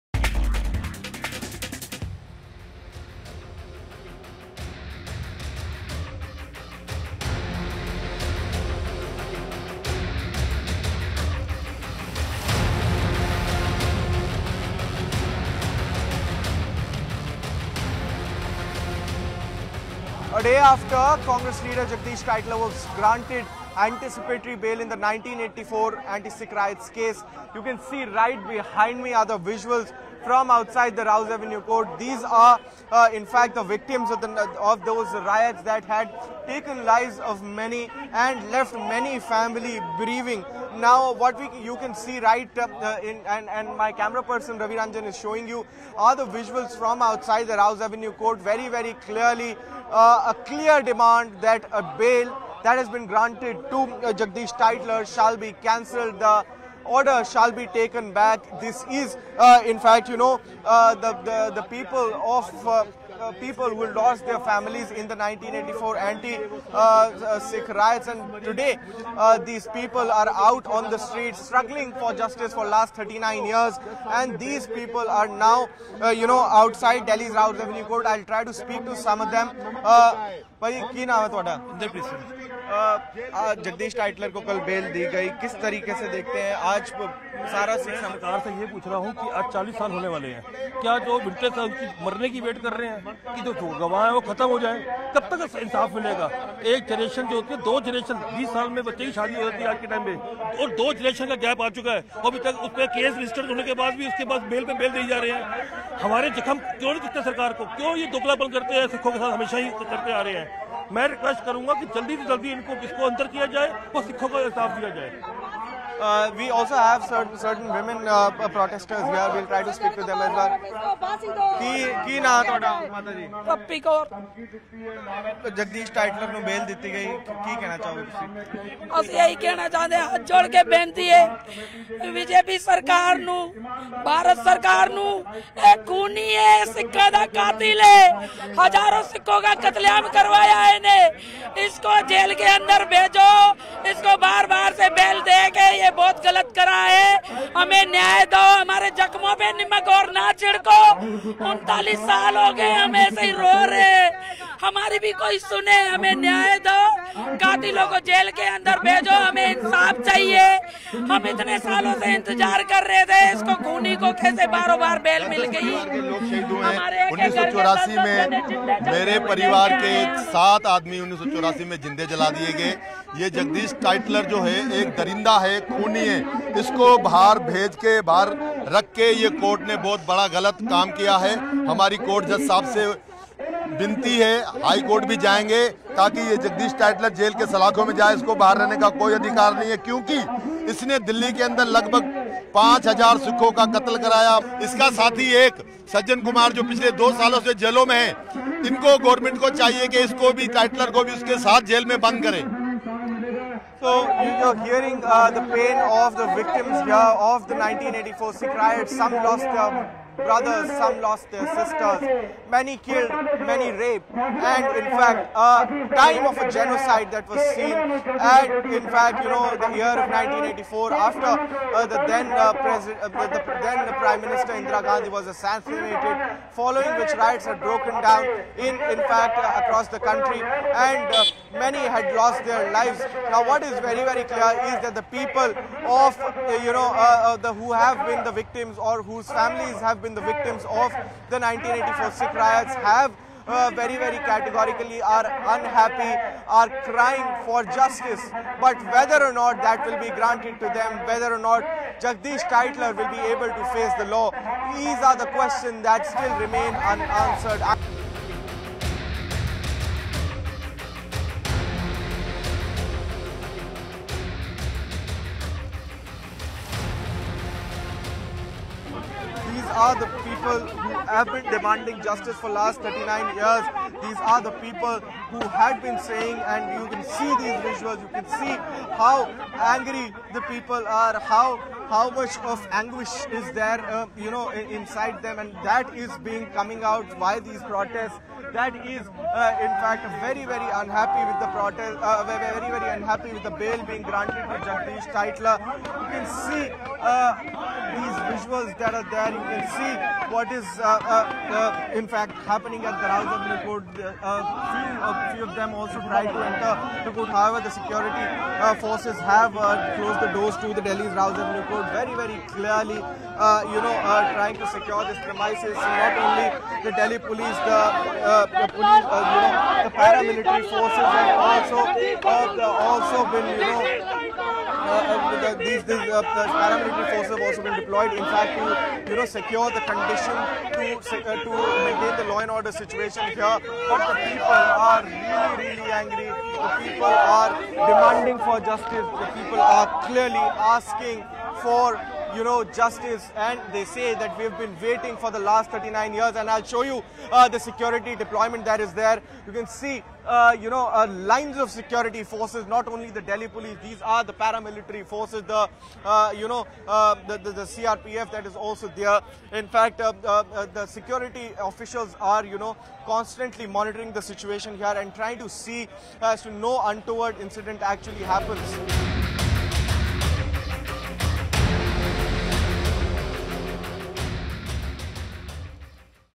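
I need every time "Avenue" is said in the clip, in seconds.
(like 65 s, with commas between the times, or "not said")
31 s, 47 s, 77 s.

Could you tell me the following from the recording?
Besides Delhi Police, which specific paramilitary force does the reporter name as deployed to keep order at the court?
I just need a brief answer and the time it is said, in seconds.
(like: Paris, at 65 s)
CRPF, at 357 s.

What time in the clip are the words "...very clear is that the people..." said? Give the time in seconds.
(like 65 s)
234 s.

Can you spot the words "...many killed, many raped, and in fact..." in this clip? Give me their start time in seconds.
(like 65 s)
212 s.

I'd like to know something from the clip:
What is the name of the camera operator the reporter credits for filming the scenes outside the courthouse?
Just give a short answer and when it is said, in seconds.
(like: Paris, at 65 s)
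Ravi Ranjan, at 44 s.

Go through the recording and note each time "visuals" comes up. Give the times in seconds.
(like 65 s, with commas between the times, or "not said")
29 s, 46 s, 277 s, 298 s.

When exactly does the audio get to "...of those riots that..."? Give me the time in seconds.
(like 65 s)
34 s.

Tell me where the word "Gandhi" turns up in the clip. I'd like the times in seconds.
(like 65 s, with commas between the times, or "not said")
224 s.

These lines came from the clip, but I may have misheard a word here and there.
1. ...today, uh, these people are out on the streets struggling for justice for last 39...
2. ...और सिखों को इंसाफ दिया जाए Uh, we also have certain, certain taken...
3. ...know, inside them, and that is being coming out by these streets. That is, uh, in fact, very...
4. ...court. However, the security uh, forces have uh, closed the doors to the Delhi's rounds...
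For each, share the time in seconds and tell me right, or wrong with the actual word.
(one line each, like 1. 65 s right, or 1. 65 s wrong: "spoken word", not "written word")
1. 68 s right
2. 113 s wrong: "women", not "taken"
3. 284 s wrong: "protests", not "streets"
4. 307 s right.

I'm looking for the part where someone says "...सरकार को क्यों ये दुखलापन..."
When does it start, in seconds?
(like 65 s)
107 s.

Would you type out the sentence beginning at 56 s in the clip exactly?
The order shall be taken back.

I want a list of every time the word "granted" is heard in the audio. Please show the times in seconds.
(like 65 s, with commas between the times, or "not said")
22 s, 53 s, 250 s, 294 s.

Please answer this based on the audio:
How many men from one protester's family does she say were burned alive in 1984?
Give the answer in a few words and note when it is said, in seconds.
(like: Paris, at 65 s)
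7, at 170 s.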